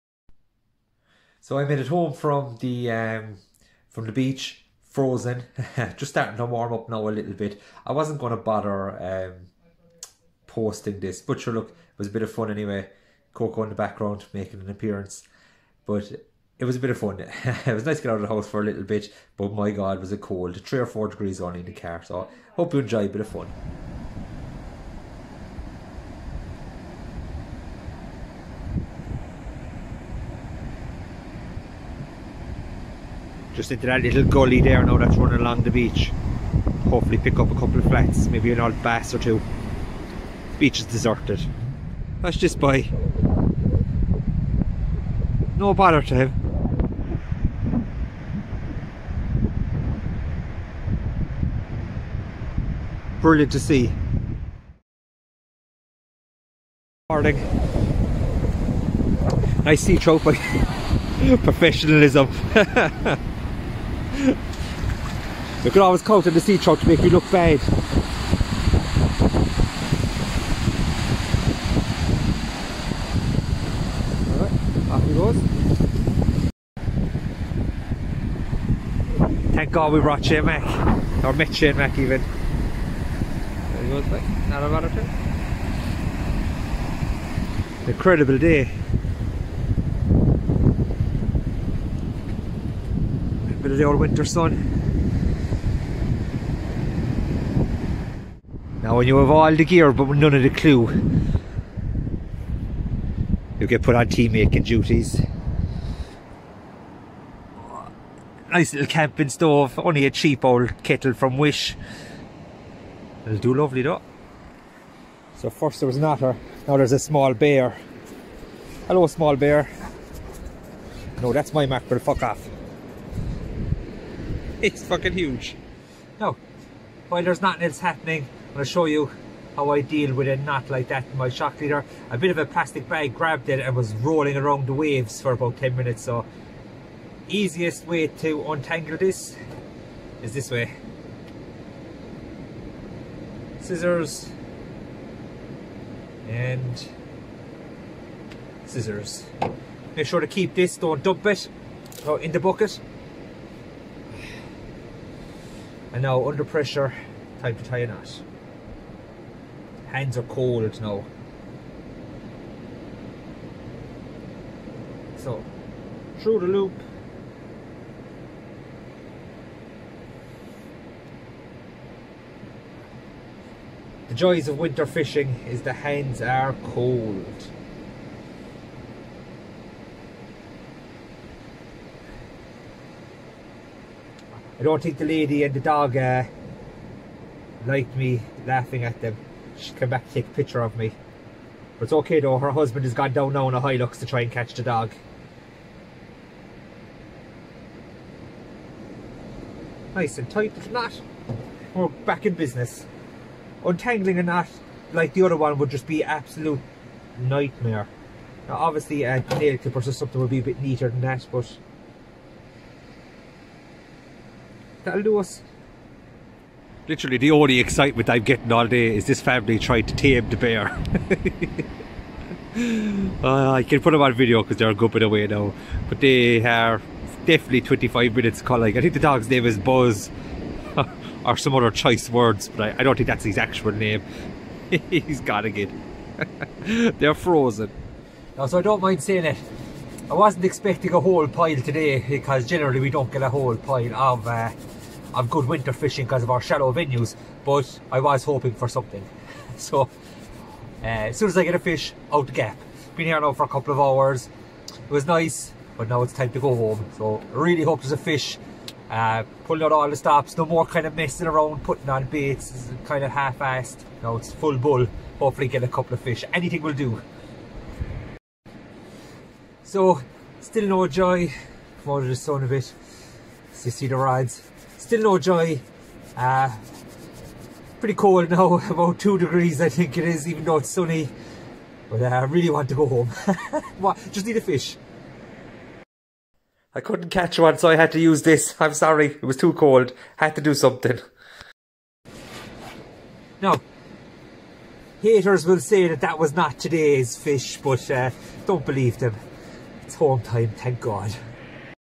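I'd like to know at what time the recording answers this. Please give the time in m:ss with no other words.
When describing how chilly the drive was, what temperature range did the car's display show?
0:20.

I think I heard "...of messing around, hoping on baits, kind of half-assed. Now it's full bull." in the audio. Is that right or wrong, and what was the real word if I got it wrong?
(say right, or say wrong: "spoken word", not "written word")
wrong: "putting", not "hoping".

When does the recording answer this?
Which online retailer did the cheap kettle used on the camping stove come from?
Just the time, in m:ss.
1:51.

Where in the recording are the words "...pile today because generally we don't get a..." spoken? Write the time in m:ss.
4:01.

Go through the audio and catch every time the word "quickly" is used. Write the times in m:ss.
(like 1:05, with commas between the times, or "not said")
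not said.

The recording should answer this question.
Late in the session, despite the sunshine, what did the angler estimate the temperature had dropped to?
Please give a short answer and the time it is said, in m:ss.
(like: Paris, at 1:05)
2 degrees, at 4:38.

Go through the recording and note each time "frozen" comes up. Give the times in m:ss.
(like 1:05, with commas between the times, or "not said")
0:04, 3:57.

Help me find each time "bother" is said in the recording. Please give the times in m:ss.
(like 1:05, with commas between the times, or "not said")
0:08, 0:45.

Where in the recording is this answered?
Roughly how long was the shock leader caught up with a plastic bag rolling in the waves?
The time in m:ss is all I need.
2:15.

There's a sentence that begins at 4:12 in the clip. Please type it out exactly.
Been here now for a couple of hours.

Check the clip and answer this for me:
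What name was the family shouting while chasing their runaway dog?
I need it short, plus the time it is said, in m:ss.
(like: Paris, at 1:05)
Buzz, at 3:49.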